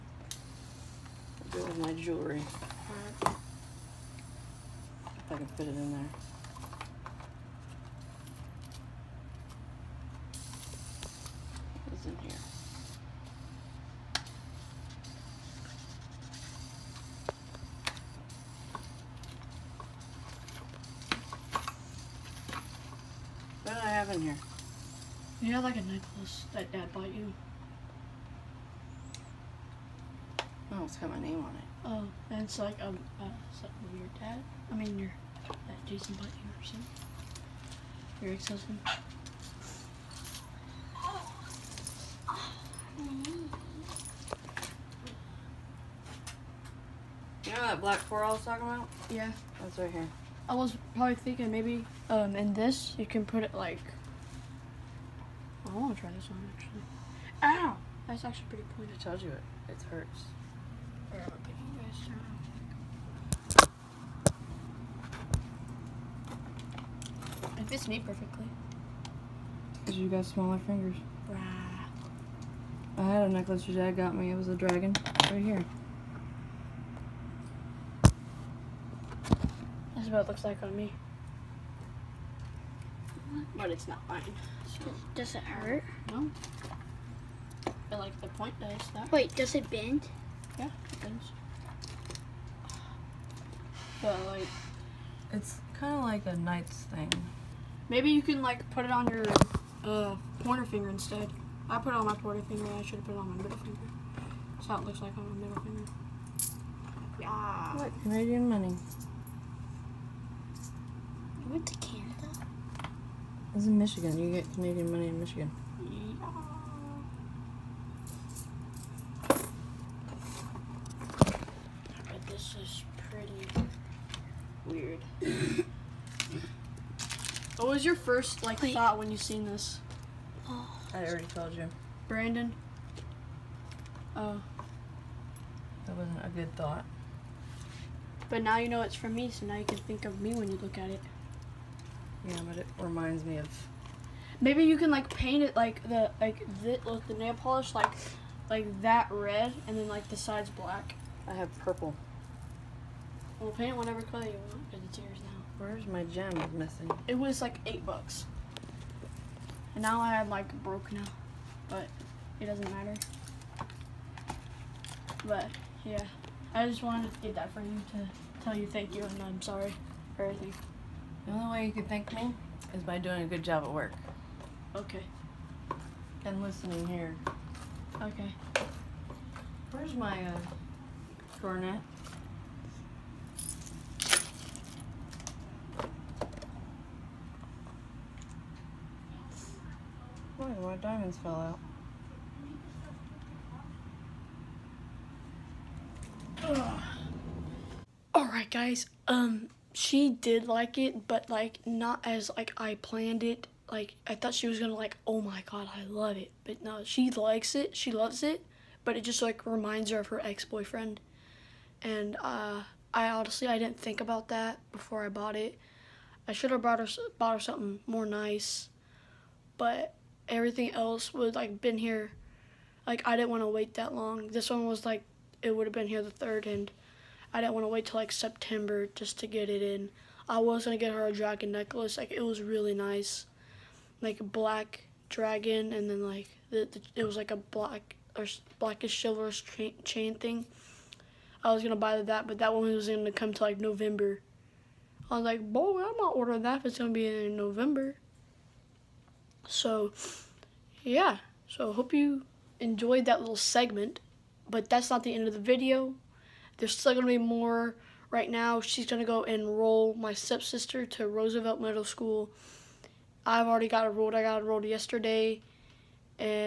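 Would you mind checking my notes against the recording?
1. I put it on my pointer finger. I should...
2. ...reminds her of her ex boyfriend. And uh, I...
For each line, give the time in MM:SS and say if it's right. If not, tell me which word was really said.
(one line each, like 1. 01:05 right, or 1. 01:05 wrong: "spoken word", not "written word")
1. 01:41 right
2. 03:29 right.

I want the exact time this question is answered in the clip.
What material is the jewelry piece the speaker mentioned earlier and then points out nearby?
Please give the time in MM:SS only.
00:47.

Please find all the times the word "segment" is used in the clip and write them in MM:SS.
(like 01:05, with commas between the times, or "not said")
04:13.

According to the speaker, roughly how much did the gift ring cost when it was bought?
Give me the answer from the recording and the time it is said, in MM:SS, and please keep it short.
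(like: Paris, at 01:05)
8 bucks, at 02:37.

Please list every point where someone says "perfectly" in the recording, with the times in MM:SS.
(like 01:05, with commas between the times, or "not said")
01:08.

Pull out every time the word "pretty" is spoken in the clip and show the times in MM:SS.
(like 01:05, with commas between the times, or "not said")
00:58, 02:03.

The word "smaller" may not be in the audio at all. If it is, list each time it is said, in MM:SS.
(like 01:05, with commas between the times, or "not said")
01:10.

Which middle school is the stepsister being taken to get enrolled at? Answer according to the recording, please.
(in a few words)
Roosevelt Middle School.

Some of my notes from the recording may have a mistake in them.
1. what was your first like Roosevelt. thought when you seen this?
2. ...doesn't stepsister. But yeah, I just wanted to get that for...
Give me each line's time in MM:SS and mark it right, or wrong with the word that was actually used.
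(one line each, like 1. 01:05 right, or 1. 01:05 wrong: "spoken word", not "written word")
1. 02:07 wrong: "Wait", not "Roosevelt"
2. 02:42 wrong: "matter", not "stepsister".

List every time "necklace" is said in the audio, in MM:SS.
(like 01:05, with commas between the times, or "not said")
01:13, 03:51.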